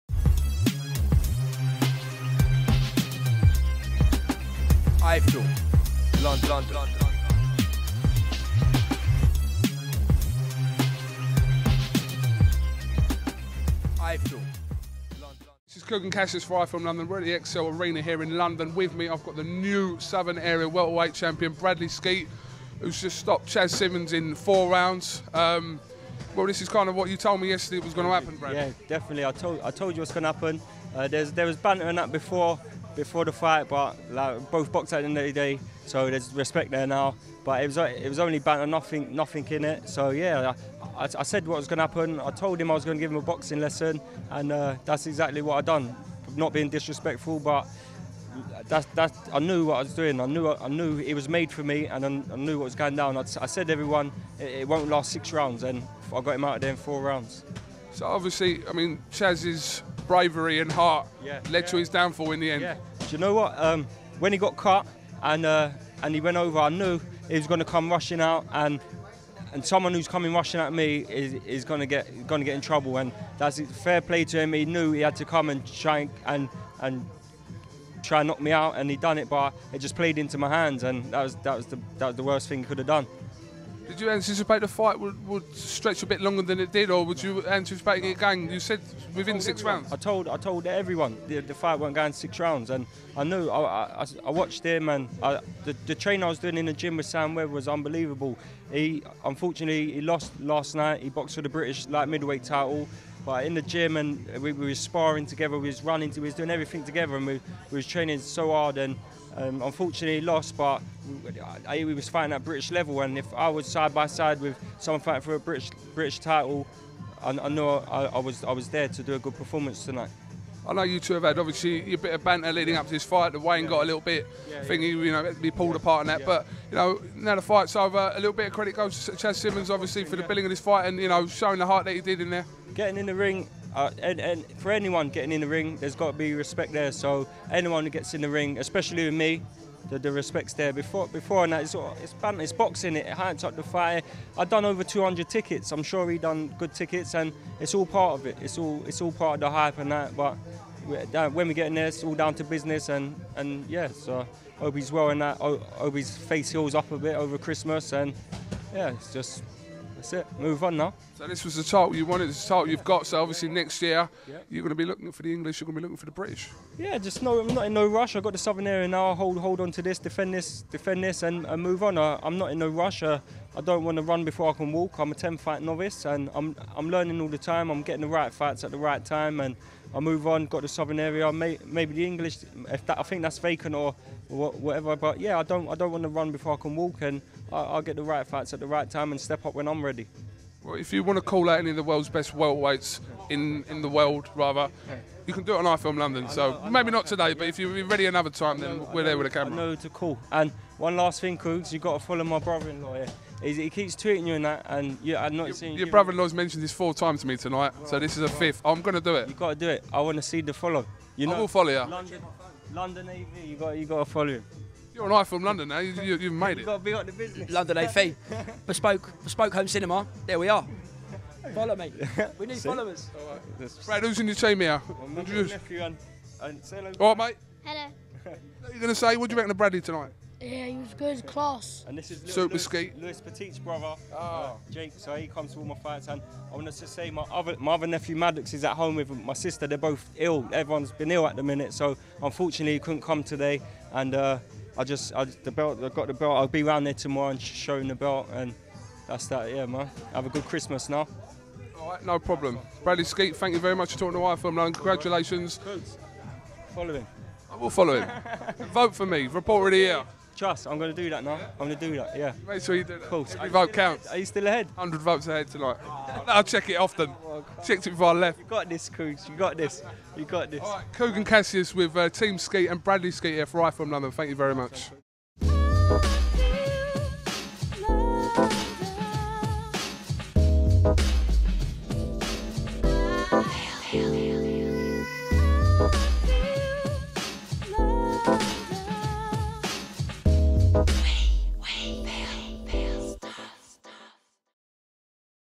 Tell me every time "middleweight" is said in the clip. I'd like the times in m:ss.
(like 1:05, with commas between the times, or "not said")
1:42.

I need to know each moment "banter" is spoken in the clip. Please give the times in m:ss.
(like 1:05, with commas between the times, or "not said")
0:31, 0:38, 2:02.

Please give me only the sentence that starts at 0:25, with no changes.
Um, well, this is kind of what you told me yesterday was going to happen, Bradley.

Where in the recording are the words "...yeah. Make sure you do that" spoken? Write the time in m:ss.
4:22.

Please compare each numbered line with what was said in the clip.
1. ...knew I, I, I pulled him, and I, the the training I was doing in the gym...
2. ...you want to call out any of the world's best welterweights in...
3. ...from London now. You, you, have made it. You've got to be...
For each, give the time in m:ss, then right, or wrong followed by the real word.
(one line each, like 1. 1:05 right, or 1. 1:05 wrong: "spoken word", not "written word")
1. 1:33 wrong: "watched", not "pulled"
2. 3:10 right
3. 3:35 right.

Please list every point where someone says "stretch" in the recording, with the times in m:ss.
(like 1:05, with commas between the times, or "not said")
1:25.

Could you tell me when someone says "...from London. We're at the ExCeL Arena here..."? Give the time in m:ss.
0:16.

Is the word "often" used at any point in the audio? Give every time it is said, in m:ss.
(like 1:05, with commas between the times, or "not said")
4:26.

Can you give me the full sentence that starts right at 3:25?
brother-in-law's mentioned this four times to me tonight, right, so this is a right.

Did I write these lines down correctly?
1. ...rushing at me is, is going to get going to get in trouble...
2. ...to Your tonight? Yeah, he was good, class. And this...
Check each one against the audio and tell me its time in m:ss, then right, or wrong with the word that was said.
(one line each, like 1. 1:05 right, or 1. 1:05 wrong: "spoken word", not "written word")
1. 1:10 right
2. 3:49 wrong: "Bradley", not "Your".